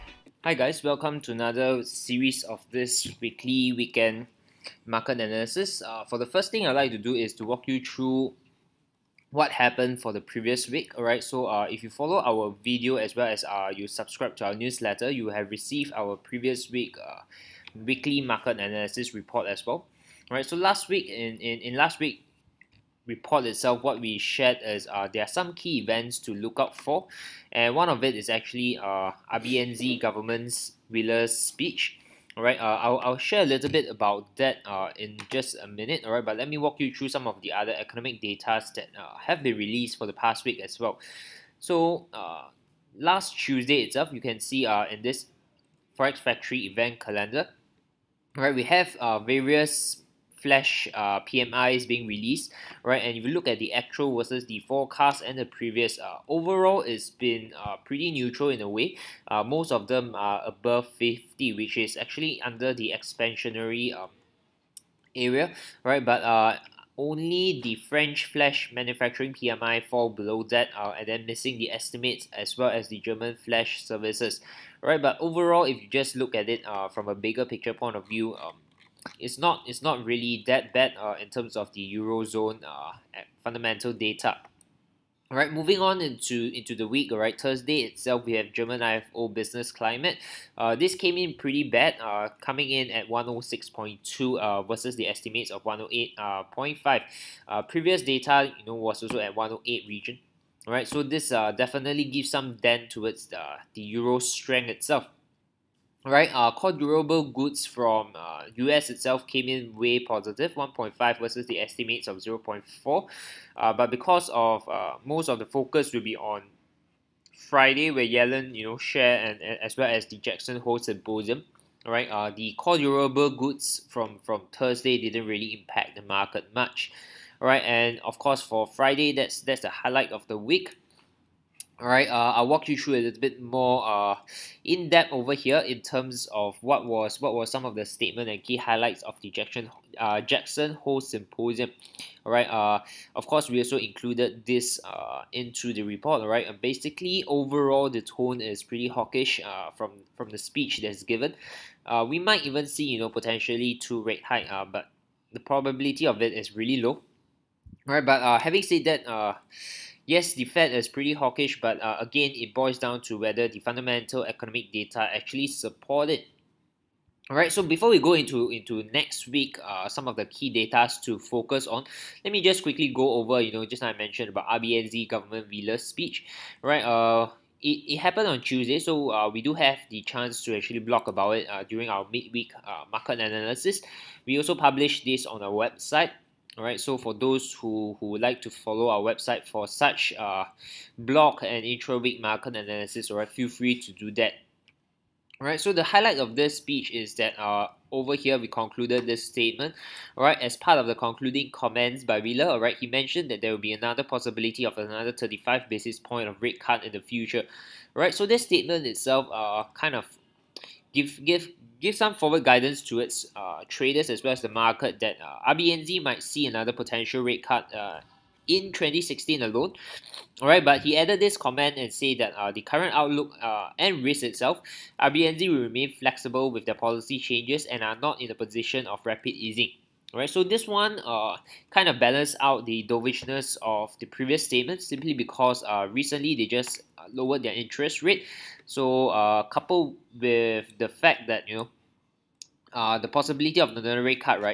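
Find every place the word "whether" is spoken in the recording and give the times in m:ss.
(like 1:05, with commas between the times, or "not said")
2:43.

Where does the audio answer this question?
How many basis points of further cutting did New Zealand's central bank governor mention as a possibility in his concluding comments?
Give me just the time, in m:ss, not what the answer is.
3:25.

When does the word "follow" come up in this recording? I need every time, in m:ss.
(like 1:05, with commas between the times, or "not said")
0:11, 3:08.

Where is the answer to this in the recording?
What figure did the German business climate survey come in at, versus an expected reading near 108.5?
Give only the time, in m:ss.
1:33.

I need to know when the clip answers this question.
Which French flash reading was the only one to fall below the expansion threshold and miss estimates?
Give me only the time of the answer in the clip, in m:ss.
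1:07.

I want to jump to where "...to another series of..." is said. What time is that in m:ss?
0:01.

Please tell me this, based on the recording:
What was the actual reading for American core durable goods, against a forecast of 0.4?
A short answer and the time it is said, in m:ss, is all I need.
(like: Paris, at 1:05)
1.5, at 1:50.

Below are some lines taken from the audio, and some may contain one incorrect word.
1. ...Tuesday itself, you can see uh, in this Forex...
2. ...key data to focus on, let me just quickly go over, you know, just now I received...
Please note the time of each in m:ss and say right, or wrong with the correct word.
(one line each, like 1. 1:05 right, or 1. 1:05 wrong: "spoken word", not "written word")
1. 0:43 right
2. 2:50 wrong: "mentioned", not "received".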